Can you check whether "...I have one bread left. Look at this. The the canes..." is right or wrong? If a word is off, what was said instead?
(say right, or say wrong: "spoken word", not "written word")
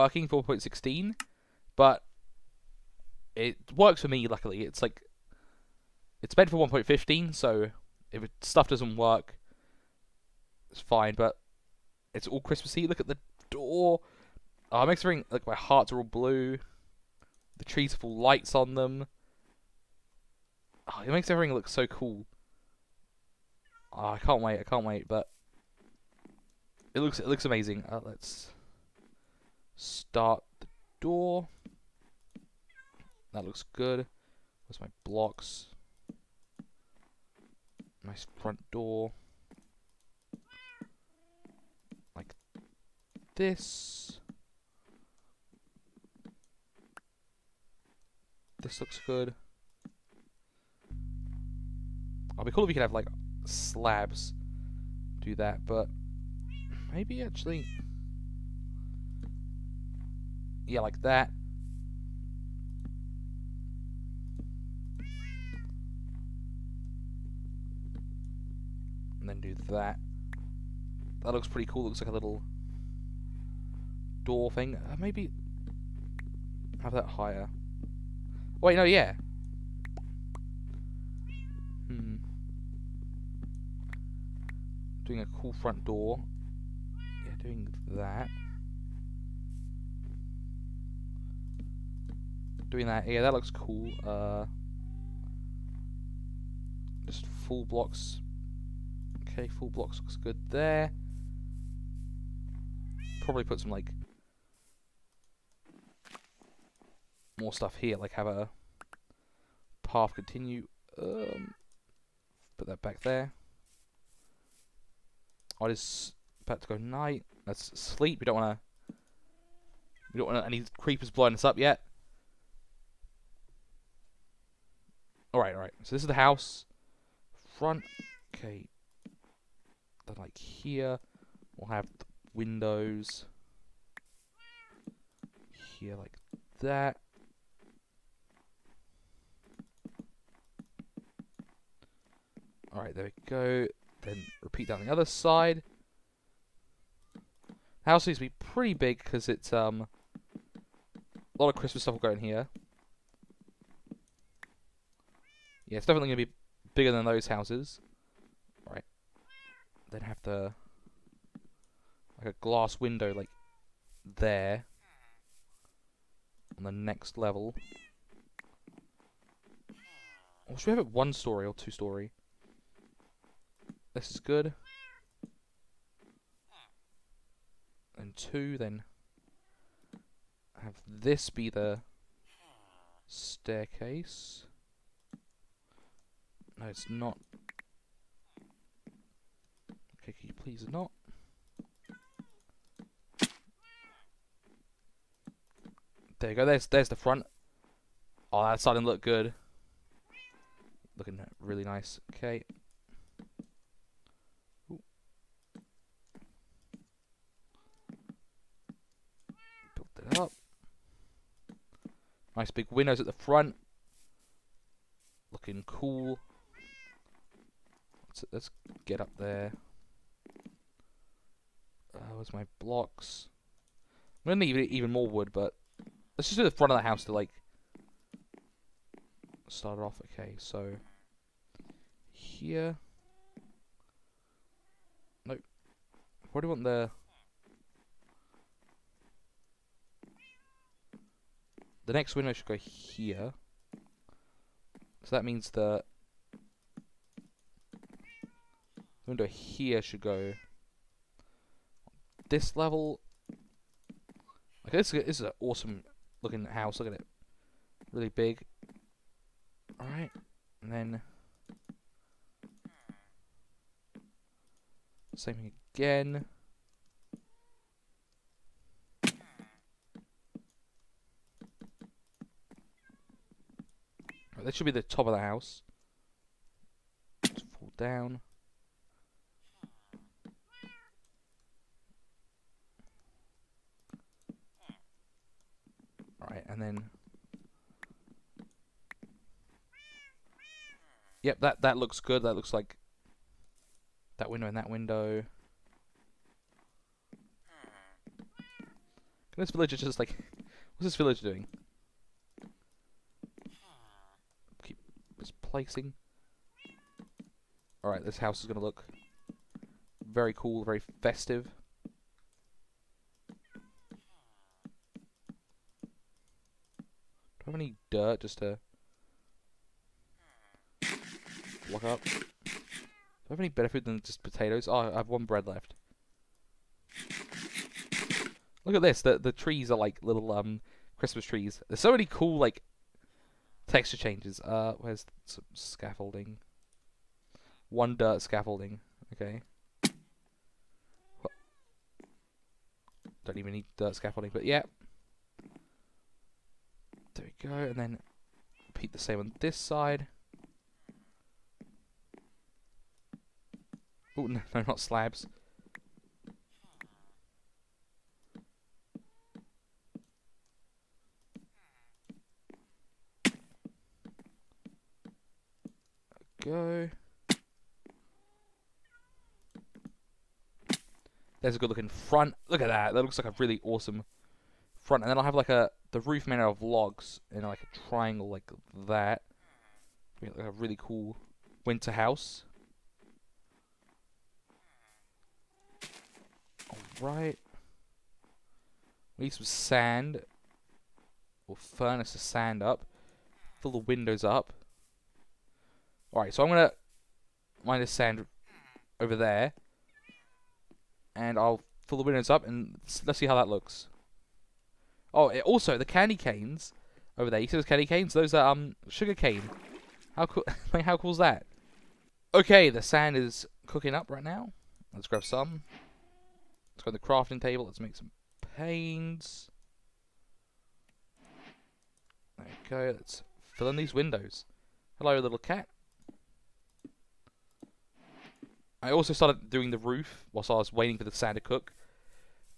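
wrong: "trees", not "canes".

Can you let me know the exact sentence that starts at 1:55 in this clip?
Oh, I just about to go night.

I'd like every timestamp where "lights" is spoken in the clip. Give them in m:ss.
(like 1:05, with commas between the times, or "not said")
0:18.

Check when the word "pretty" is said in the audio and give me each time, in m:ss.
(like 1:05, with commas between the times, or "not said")
1:11, 2:28.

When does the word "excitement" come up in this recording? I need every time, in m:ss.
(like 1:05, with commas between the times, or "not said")
not said.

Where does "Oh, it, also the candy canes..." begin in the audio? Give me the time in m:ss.
6:45.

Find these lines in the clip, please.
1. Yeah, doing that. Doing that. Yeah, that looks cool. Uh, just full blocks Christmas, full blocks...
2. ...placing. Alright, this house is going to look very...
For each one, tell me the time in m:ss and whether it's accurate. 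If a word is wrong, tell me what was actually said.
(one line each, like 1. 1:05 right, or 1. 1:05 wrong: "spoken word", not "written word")
1. 1:27 wrong: "Okay", not "Christmas"
2. 5:05 right.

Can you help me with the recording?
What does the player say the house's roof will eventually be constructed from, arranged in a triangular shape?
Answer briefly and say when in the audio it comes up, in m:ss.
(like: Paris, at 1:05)
Logs, at 6:16.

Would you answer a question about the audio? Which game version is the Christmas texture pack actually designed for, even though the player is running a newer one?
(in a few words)
1.15.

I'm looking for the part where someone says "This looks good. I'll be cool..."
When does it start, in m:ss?
0:48.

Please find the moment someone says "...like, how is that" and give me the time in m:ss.
6:50.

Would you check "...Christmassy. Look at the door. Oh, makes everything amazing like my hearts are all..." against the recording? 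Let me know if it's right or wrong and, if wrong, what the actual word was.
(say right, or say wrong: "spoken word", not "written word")
wrong: "expecting", not "amazing".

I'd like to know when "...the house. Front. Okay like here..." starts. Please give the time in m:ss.
2:06.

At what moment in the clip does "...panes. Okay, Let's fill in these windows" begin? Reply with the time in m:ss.
6:58.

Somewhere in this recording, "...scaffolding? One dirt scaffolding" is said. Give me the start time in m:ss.
5:35.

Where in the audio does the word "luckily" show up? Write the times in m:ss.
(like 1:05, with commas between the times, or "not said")
0:04.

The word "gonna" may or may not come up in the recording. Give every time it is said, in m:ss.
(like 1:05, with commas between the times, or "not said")
2:36, 3:44, 6:36.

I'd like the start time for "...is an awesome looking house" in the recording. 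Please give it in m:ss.
4:15.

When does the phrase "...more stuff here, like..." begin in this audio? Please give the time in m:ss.
1:47.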